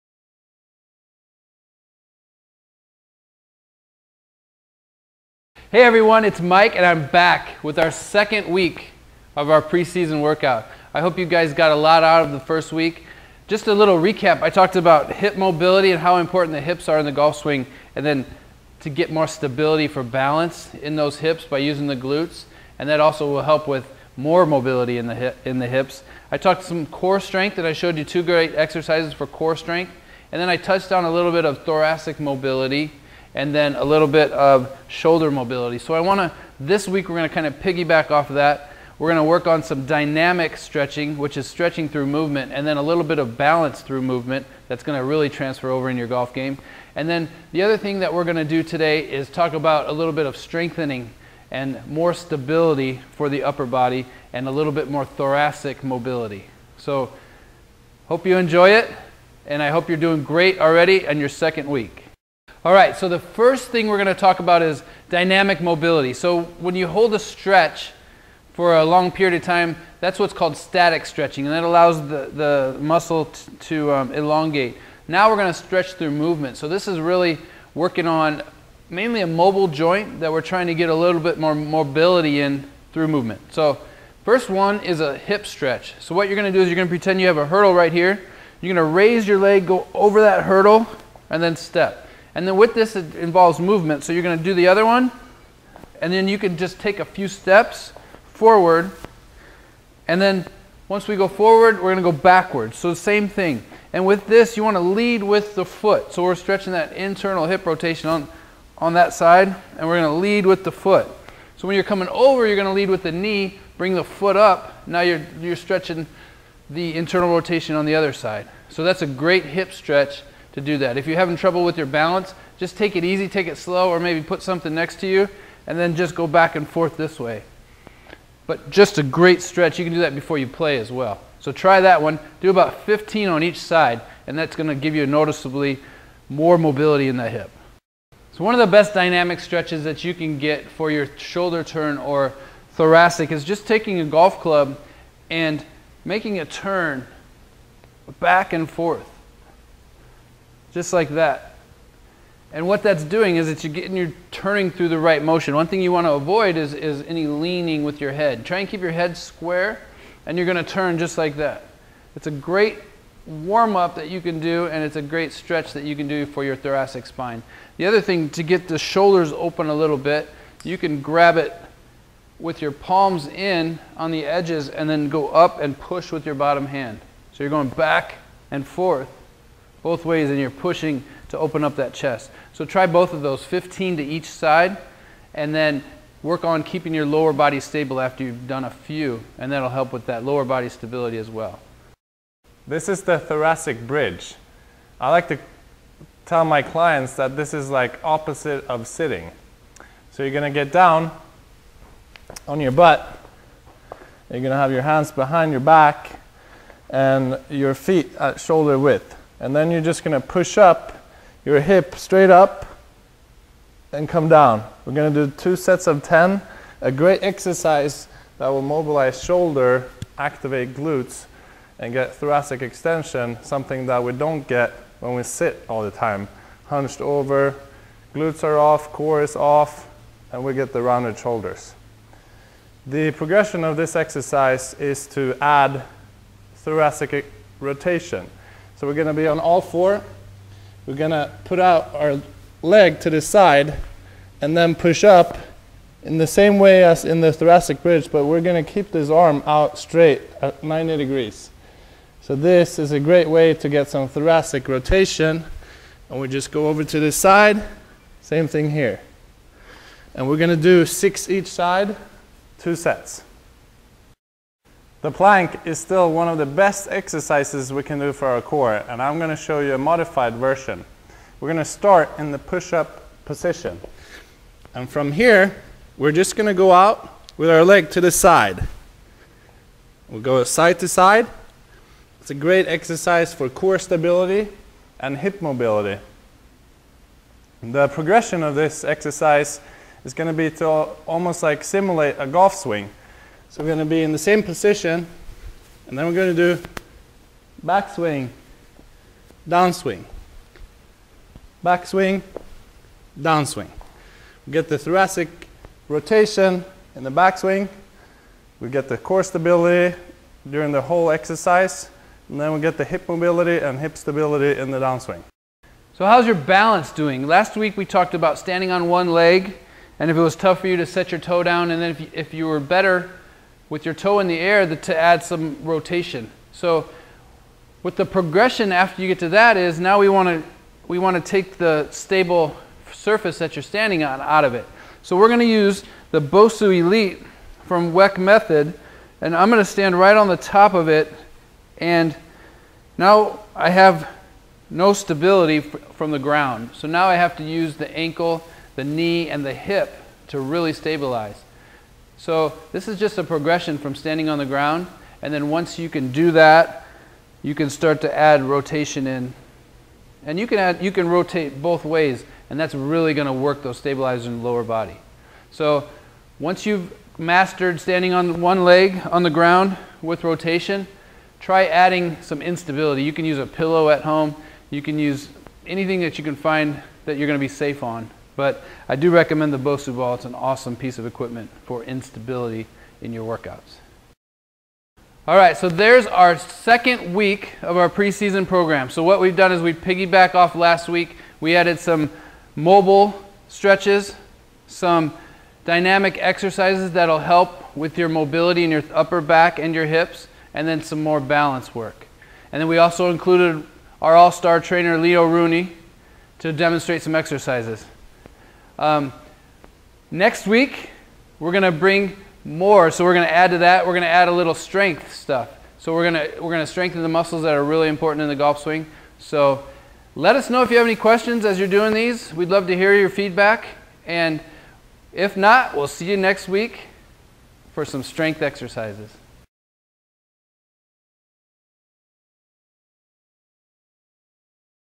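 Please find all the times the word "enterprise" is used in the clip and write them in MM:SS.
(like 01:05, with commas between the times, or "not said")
not said.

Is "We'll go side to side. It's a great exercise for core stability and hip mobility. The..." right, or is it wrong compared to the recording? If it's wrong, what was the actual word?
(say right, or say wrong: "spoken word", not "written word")
right.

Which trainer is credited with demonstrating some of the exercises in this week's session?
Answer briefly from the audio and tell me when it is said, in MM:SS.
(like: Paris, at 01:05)
Leo Rooney, at 06:44.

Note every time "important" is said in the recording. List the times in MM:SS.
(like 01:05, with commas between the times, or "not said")
00:16, 06:57.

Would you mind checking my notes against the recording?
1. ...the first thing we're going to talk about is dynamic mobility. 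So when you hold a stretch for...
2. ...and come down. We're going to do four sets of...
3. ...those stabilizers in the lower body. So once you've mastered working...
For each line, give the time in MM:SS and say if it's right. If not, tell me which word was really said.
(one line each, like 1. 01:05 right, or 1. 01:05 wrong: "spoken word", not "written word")
1. 01:03 right
2. 03:33 wrong: "two", not "four"
3. 06:03 wrong: "standing", not "working".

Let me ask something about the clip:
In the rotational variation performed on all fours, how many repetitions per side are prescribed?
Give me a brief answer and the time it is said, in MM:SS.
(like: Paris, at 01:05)
6, at 04:20.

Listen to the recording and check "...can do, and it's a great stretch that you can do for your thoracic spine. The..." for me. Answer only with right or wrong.
right.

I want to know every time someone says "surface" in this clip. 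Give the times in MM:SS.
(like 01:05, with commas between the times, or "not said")
05:32.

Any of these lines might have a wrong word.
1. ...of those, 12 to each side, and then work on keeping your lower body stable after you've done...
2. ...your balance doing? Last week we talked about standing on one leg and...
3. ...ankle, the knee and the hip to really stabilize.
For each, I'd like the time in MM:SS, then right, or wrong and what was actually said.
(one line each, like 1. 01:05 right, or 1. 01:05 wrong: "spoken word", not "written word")
1. 03:03 wrong: "15", not "12"
2. 05:16 right
3. 05:47 right.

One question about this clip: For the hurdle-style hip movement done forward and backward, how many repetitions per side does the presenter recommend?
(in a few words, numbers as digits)
15.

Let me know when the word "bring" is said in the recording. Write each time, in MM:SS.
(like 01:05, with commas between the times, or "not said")
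01:53, 06:51.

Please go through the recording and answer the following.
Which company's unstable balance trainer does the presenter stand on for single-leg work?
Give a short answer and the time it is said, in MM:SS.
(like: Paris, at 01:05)
Weck Method, at 05:37.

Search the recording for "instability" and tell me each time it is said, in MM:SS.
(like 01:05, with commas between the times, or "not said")
06:12, 06:21.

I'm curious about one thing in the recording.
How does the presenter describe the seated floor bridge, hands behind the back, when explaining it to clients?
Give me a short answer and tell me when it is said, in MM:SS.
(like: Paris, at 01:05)
Opposite of sitting, at 03:18.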